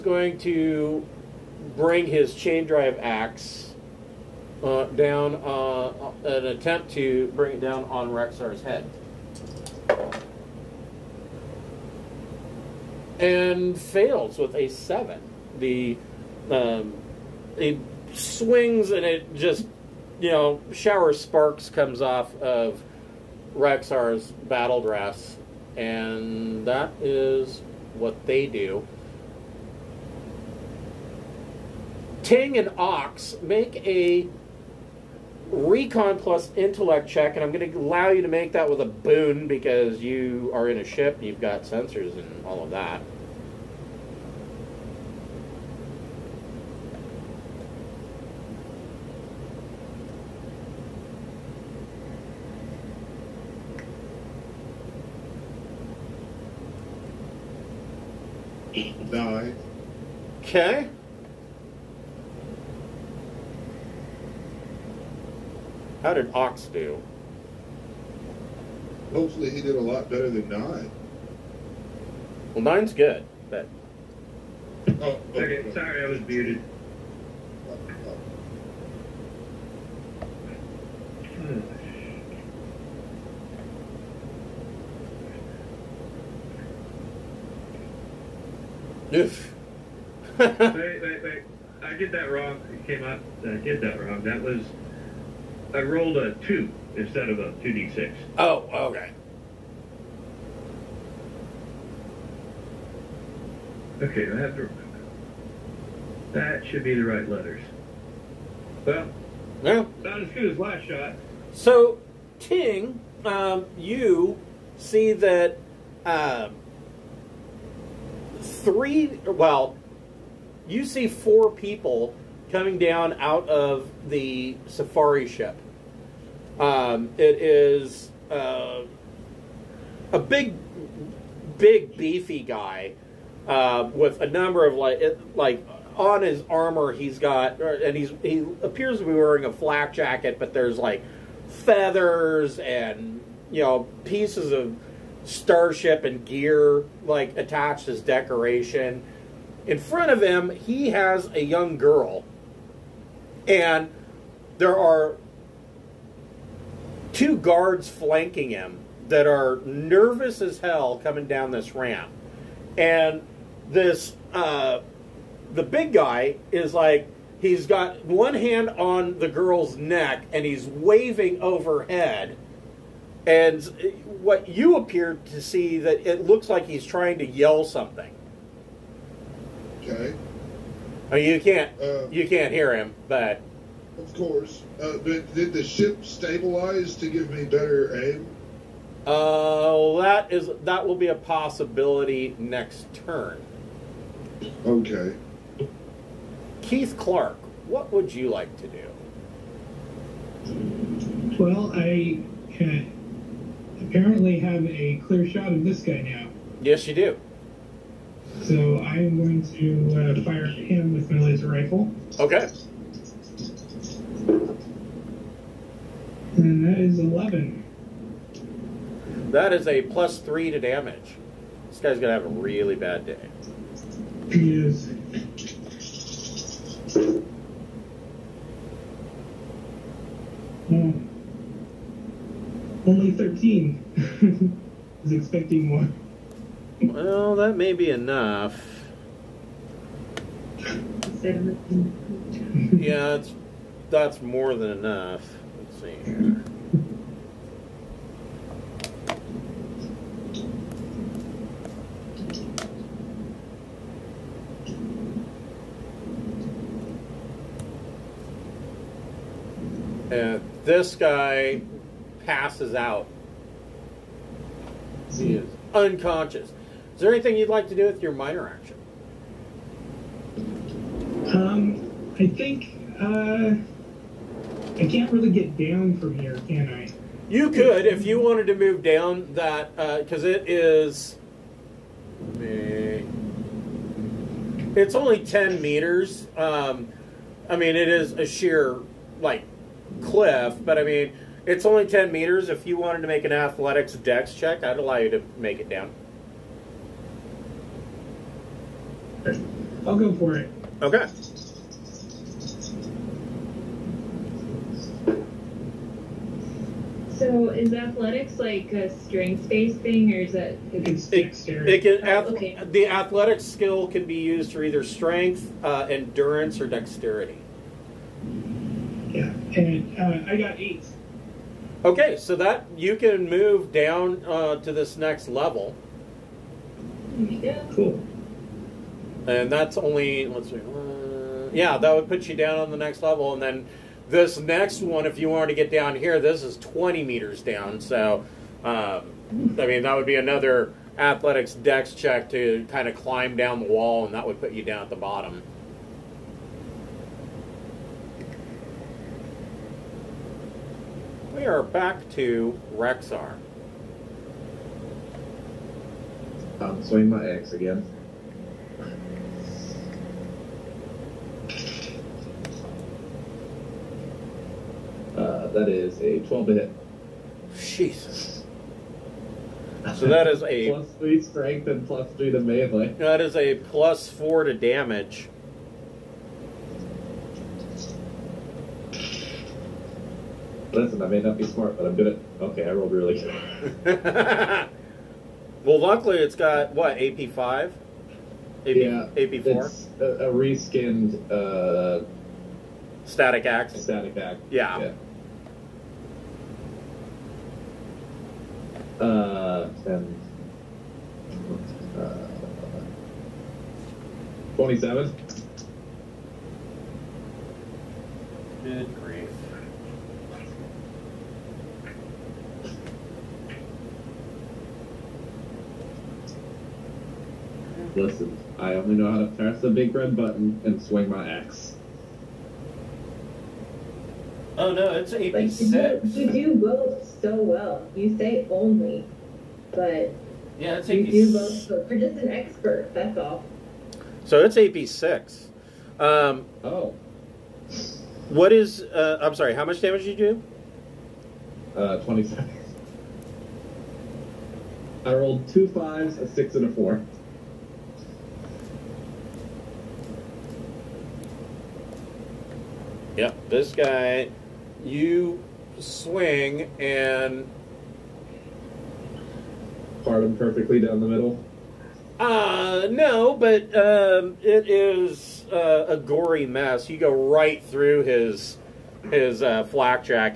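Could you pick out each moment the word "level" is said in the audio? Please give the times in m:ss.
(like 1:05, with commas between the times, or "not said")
5:25, 5:33.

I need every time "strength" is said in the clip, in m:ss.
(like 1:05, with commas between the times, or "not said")
5:08, 5:14, 6:11.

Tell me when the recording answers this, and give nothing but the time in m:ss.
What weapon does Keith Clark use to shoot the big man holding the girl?
3:31.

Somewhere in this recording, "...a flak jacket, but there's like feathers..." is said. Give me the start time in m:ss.
2:19.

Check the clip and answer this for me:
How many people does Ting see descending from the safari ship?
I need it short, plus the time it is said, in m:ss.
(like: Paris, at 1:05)
4, at 2:01.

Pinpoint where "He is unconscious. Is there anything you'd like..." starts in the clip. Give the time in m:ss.
4:25.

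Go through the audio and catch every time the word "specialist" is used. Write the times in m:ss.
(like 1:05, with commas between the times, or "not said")
not said.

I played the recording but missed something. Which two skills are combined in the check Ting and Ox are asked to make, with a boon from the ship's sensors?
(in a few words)
Recon plus intellect.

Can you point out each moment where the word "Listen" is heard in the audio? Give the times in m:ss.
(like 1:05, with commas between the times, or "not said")
6:20, 6:57.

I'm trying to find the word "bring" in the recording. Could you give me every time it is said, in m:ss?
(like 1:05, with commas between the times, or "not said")
0:01, 0:07.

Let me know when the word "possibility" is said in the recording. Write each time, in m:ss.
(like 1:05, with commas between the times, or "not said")
3:11.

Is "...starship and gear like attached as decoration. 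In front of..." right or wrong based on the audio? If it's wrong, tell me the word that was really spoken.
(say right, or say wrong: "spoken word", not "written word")
right.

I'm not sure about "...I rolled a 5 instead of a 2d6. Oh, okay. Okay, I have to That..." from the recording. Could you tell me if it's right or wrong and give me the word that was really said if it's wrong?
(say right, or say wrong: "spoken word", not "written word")
wrong: "2", not "5".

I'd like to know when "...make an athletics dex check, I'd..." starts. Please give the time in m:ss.
4:53.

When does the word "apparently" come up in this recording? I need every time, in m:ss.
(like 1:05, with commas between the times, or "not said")
3:23.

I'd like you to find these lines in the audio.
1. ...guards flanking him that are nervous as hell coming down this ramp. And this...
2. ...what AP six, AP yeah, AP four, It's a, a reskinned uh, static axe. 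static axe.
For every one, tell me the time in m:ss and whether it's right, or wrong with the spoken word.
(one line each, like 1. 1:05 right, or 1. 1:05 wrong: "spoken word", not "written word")
1. 2:37 right
2. 6:26 wrong: "five", not "six".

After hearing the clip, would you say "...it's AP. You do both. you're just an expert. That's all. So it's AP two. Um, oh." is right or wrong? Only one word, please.
wrong.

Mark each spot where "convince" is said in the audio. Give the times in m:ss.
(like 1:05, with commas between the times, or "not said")
not said.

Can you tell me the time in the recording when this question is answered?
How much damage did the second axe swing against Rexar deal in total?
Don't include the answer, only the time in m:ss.
7:21.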